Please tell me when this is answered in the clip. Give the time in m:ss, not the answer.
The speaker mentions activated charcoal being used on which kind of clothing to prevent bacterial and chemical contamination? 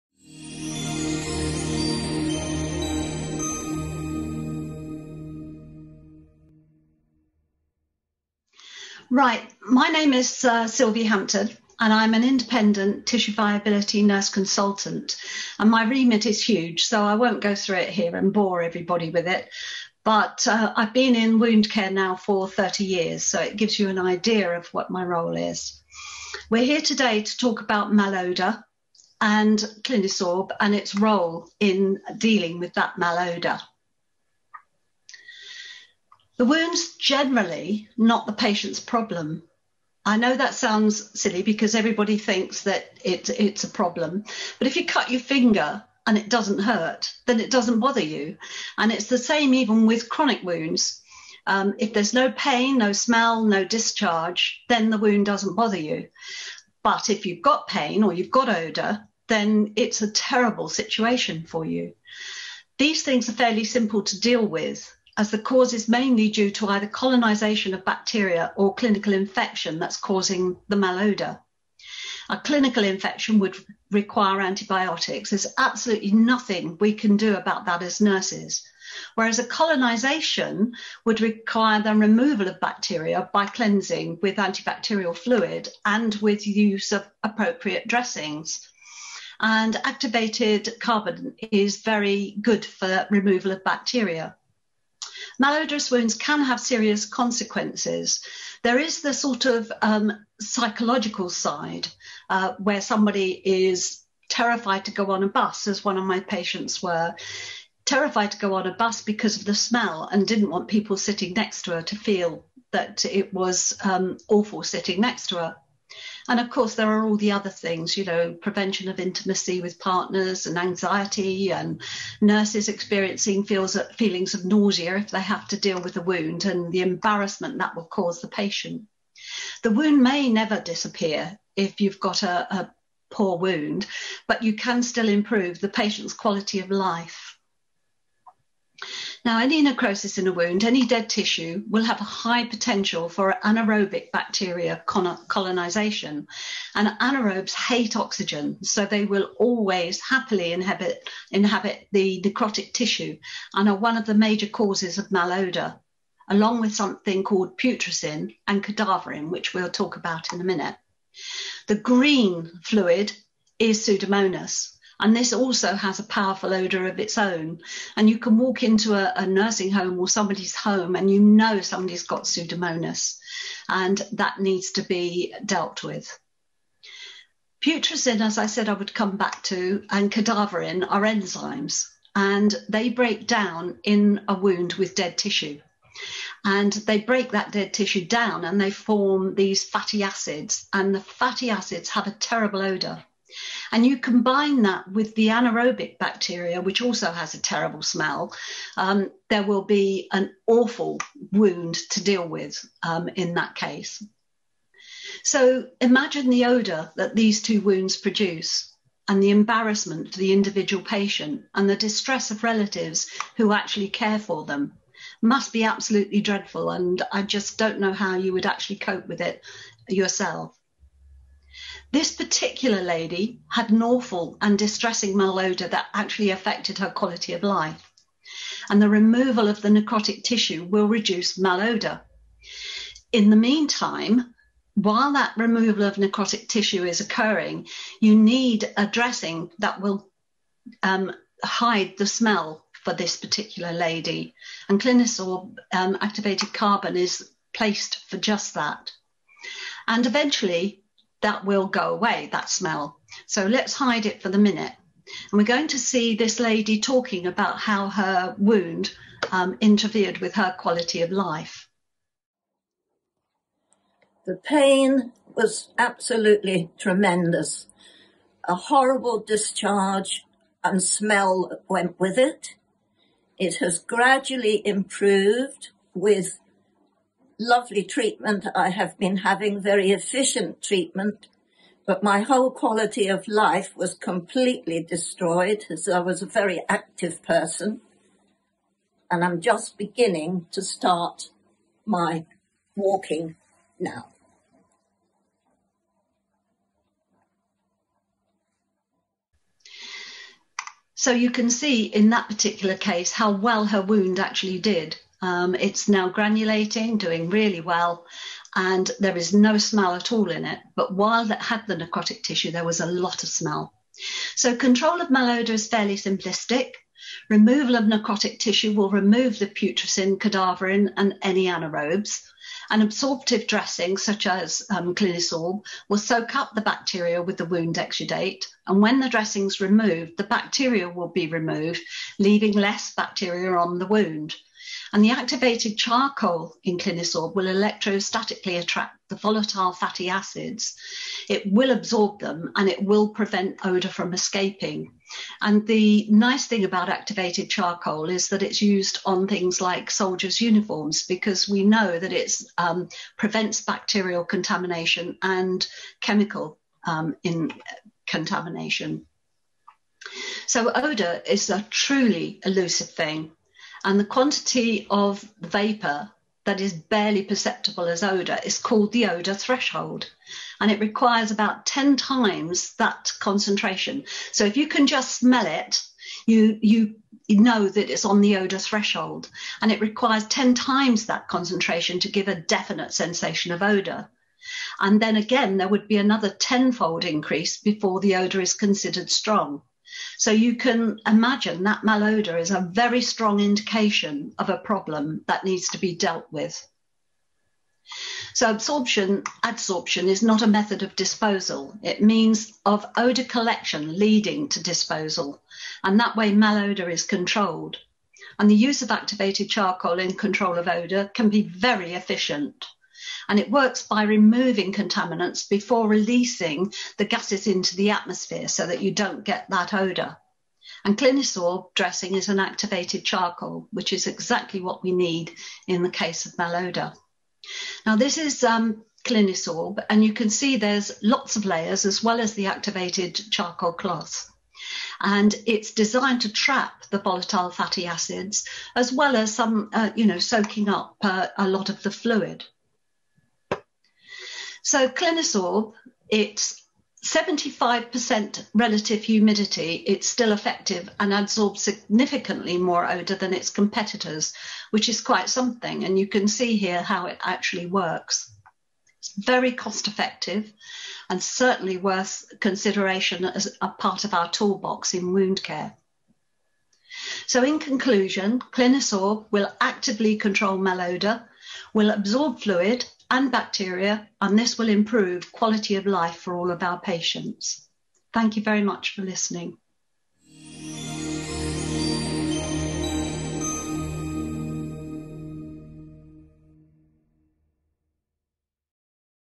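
5:49.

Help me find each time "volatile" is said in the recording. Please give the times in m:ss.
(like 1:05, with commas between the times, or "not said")
5:39, 7:16.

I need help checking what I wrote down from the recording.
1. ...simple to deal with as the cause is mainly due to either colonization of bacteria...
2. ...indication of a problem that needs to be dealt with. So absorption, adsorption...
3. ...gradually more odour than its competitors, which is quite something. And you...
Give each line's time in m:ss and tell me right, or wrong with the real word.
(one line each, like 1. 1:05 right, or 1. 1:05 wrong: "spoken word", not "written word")
1. 1:03 right
2. 6:33 right
3. 7:31 wrong: "significantly", not "gradually".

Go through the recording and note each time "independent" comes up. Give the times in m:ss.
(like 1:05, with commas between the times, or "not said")
0:12.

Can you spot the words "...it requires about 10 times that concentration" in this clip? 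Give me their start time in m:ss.
6:10.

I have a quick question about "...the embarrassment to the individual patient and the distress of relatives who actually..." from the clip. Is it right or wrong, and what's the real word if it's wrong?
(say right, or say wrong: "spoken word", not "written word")
right.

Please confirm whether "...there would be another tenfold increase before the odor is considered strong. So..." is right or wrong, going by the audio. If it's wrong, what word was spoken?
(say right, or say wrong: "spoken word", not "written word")
right.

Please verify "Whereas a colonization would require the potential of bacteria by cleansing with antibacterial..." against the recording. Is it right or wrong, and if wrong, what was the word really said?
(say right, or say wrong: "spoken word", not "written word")
wrong: "removal", not "potential".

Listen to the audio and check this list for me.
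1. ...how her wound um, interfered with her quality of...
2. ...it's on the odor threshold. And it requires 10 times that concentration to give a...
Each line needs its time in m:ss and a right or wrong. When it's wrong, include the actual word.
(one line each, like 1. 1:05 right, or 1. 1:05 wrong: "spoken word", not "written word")
1. 4:17 right
2. 6:17 right.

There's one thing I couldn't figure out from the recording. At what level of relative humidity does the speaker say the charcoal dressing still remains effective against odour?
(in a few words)
75%.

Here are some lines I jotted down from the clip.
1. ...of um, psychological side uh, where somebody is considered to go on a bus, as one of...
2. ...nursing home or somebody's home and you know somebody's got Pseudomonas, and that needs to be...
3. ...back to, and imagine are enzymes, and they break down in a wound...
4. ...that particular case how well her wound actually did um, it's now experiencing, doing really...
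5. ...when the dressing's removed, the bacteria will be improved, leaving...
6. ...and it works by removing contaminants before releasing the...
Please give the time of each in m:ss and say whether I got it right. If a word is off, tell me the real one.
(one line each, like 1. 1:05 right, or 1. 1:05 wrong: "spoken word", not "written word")
1. 1:39 wrong: "terrified", not "considered"
2. 2:49 right
3. 2:59 wrong: "cadaverine", not "imagine"
4. 5:02 wrong: "granulating", not "experiencing"
5. 5:28 wrong: "removed", not "improved"
6. 6:53 right.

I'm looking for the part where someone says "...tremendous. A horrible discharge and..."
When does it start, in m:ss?
4:26.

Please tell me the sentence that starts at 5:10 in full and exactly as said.
But while that had the necrotic tissue, there was a lot of smell.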